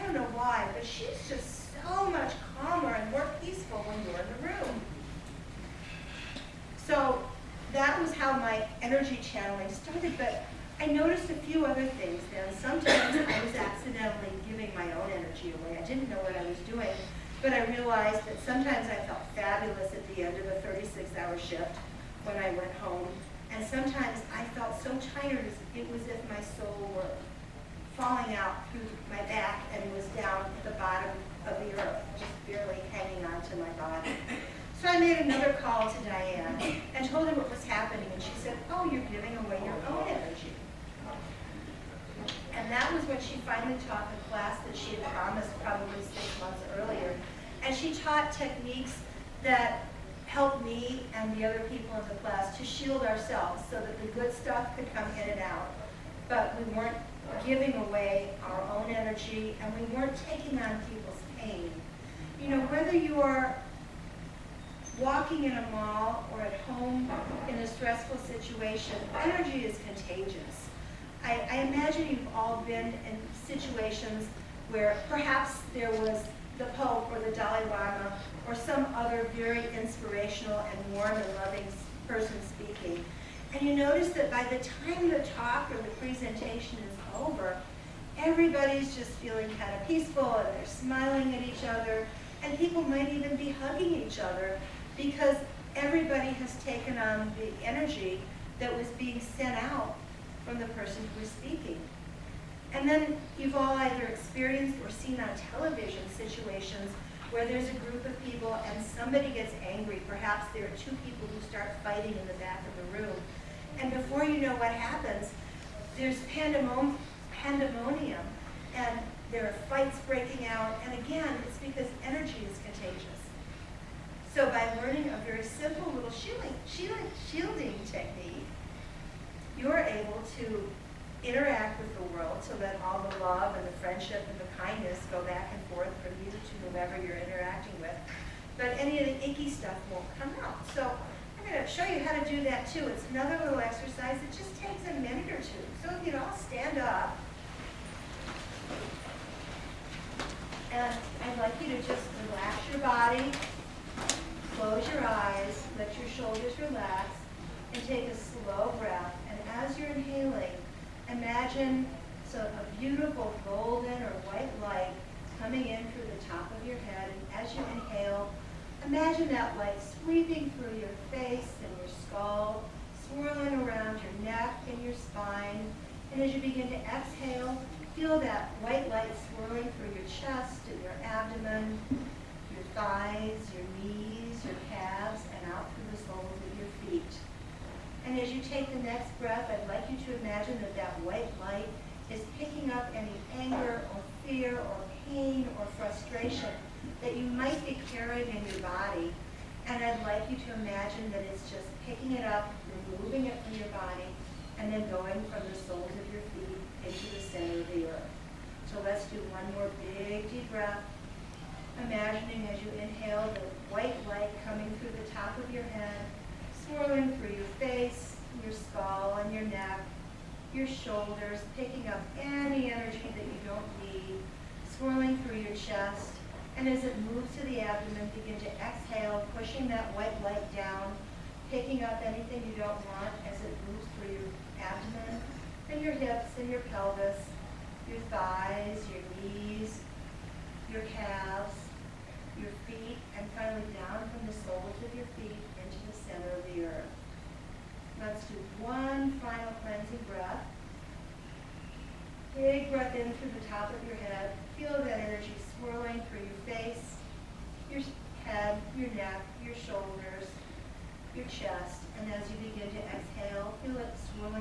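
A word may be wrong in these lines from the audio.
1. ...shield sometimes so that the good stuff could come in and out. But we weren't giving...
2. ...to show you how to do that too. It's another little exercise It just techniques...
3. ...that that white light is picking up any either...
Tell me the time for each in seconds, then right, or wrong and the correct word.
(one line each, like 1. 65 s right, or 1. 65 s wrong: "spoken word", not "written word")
1. 52 s wrong: "ourselves", not "sometimes"
2. 141 s wrong: "takes", not "techniques"
3. 190 s wrong: "anger", not "either".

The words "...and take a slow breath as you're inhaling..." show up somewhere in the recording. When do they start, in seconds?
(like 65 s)
157 s.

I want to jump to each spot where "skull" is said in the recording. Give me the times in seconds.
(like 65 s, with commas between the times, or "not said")
172 s, 218 s.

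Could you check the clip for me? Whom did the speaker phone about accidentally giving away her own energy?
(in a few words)
Diane.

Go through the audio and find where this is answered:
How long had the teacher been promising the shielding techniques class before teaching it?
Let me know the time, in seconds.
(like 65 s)
46 s.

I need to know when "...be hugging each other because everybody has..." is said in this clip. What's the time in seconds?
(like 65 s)
93 s.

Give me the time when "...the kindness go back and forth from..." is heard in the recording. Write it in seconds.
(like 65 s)
134 s.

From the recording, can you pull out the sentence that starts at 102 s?
And then you've all either experienced or seen on television situations where there's a group of people and somebody gets angry.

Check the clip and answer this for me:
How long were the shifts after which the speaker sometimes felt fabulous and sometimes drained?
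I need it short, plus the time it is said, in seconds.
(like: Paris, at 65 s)
36 hours, at 20 s.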